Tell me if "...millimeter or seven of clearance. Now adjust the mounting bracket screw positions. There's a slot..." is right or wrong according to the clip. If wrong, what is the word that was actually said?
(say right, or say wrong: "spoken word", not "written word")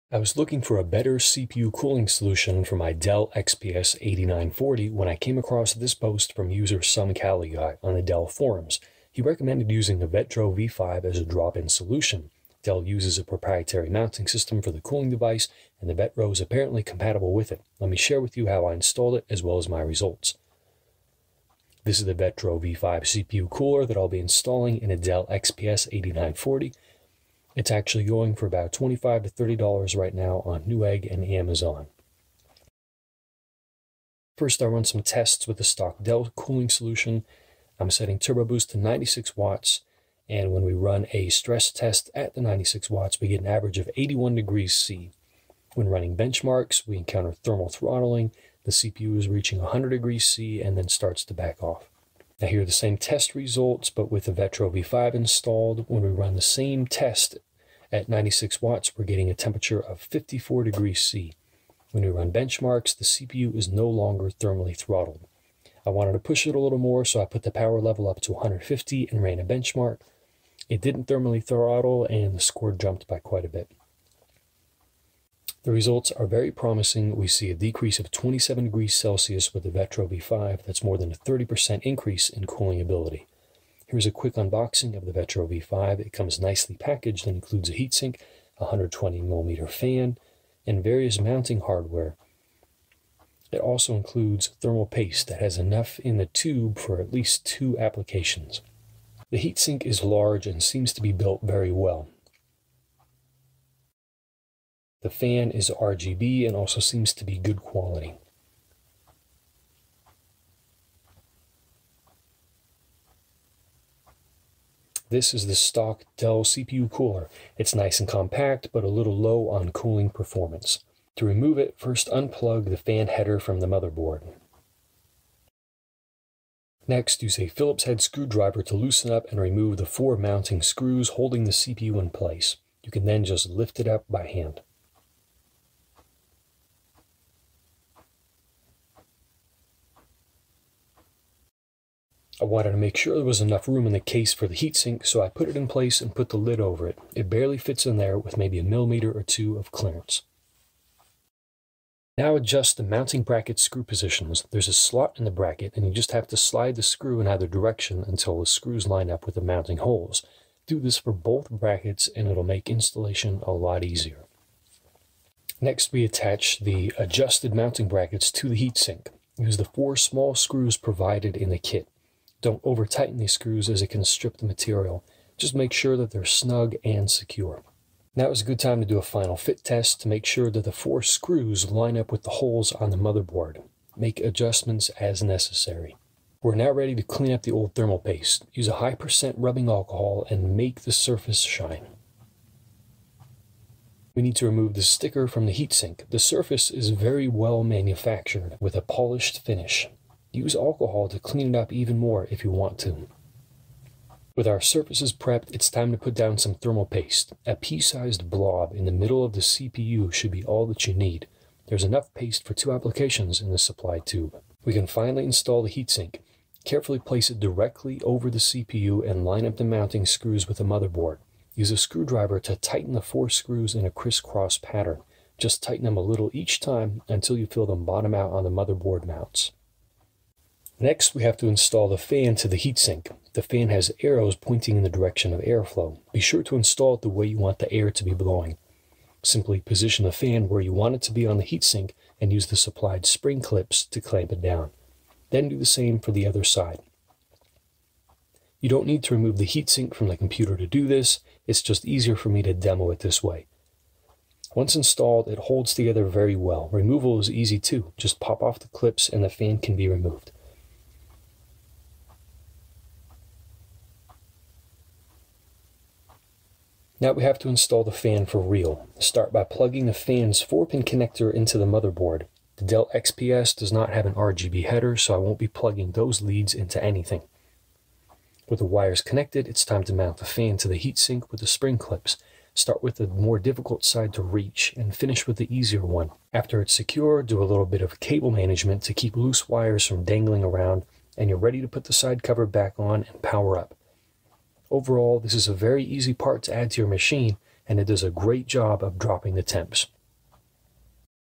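wrong: "two", not "seven".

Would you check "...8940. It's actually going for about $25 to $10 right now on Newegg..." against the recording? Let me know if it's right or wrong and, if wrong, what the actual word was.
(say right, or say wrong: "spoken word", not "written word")
wrong: "30", not "10".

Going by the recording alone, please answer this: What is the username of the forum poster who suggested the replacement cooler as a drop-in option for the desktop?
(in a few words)
SomeCaliGuy.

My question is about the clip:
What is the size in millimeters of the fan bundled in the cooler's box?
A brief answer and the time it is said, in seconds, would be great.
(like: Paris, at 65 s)
120, at 88 s.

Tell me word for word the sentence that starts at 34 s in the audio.
First, I run some tests with the stock Dell cooling solution.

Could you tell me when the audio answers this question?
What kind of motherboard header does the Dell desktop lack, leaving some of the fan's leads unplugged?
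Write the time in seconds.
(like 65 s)
274 s.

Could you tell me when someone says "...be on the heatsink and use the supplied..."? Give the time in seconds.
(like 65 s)
241 s.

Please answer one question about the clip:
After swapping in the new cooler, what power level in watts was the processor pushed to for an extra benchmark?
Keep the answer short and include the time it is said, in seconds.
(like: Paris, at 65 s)
150, at 68 s.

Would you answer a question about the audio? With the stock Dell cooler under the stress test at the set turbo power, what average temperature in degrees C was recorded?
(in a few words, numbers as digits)
81.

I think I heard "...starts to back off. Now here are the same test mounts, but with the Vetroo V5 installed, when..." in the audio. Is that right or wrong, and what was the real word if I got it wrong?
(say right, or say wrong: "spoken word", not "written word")
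wrong: "results", not "mounts".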